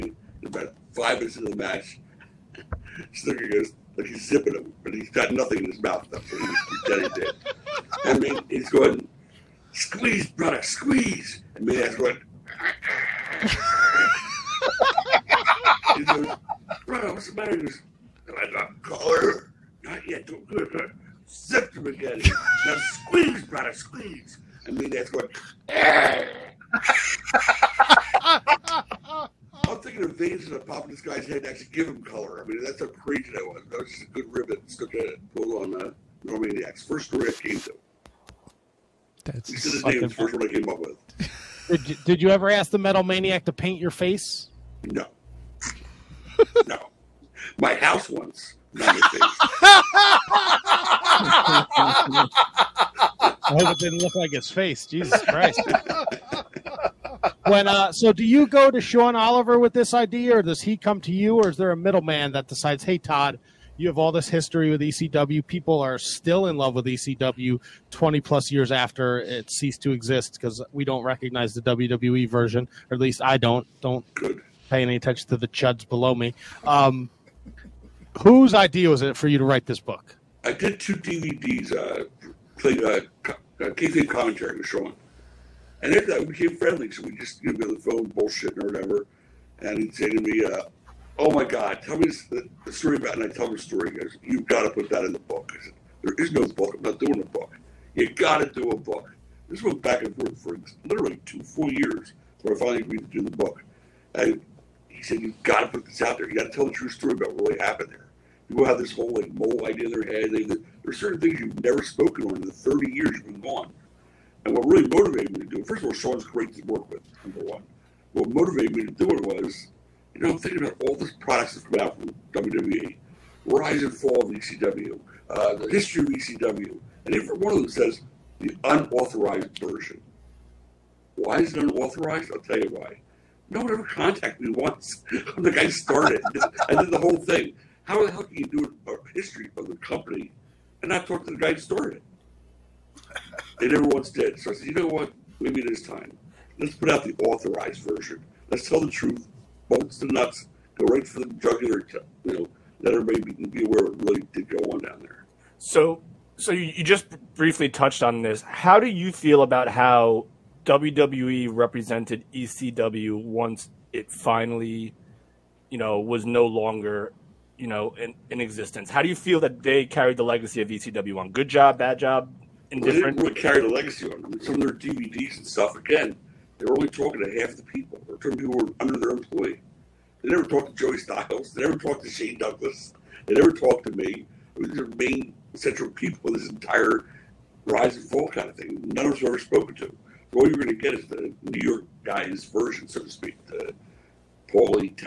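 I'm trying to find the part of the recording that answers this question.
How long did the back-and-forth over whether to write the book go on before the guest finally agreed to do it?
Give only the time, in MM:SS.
01:41.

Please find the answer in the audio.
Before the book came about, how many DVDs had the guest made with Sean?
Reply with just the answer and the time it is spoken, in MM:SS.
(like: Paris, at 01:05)
2, at 01:20.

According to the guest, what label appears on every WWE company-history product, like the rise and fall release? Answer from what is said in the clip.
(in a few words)
the unauthorized version.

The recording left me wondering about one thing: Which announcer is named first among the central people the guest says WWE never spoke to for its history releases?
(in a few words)
Joey Styles.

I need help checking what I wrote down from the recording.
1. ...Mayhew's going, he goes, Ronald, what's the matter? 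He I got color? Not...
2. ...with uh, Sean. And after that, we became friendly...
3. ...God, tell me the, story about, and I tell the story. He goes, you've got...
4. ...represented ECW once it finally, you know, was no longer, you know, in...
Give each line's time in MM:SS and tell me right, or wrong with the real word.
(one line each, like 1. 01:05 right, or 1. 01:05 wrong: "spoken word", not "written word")
1. 00:11 right
2. 01:24 right
3. 01:31 right
4. 02:41 right.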